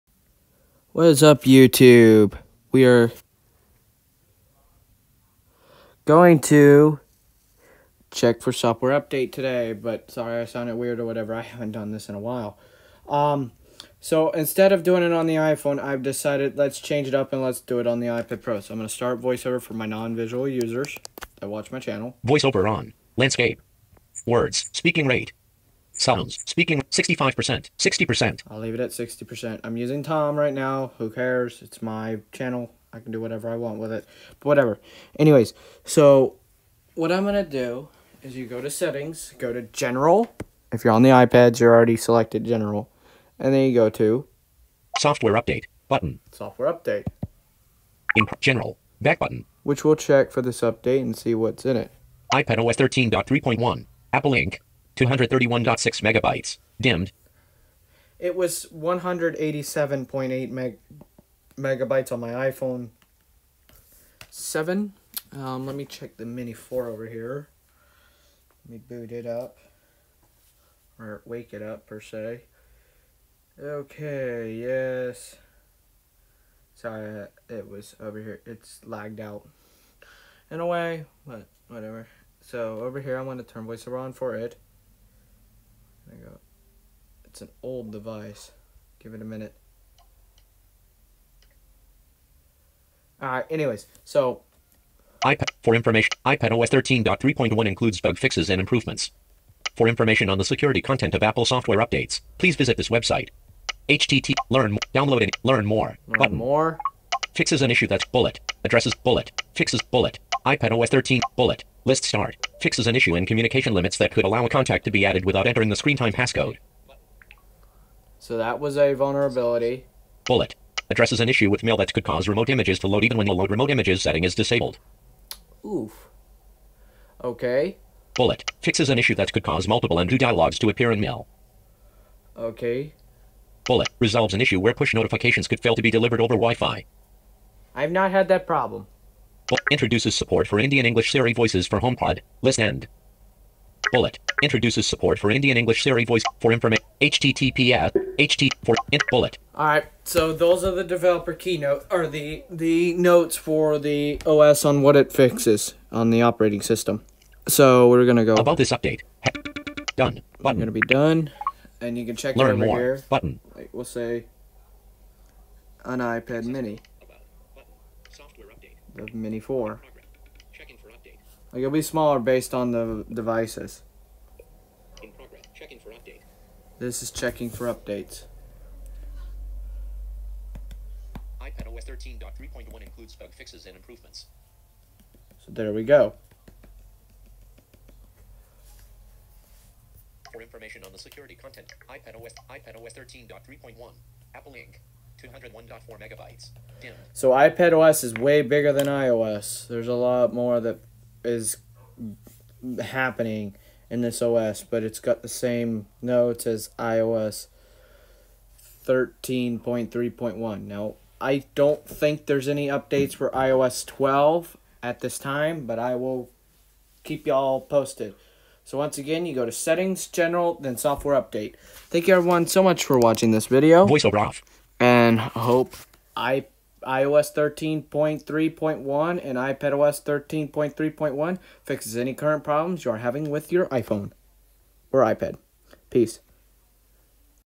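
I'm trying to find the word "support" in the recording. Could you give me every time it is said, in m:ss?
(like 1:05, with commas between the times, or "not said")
2:20, 2:24.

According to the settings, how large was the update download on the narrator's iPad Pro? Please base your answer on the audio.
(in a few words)
231.6 megabytes.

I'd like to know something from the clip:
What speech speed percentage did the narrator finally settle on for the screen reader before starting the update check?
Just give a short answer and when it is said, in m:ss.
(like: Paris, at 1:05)
60%, at 0:28.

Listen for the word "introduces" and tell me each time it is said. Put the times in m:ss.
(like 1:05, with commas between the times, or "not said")
2:19, 2:24.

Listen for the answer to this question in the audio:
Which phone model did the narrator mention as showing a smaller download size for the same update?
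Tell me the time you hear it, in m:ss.
1:02.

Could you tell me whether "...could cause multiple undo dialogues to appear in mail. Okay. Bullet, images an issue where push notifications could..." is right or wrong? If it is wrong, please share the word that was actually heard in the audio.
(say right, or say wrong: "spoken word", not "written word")
wrong: "resolves", not "images".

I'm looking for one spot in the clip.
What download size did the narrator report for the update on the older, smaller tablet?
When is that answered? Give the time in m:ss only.
3:15.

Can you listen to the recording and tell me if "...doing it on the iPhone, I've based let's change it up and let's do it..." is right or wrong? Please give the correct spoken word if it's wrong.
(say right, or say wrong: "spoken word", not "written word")
wrong: "decided", not "based".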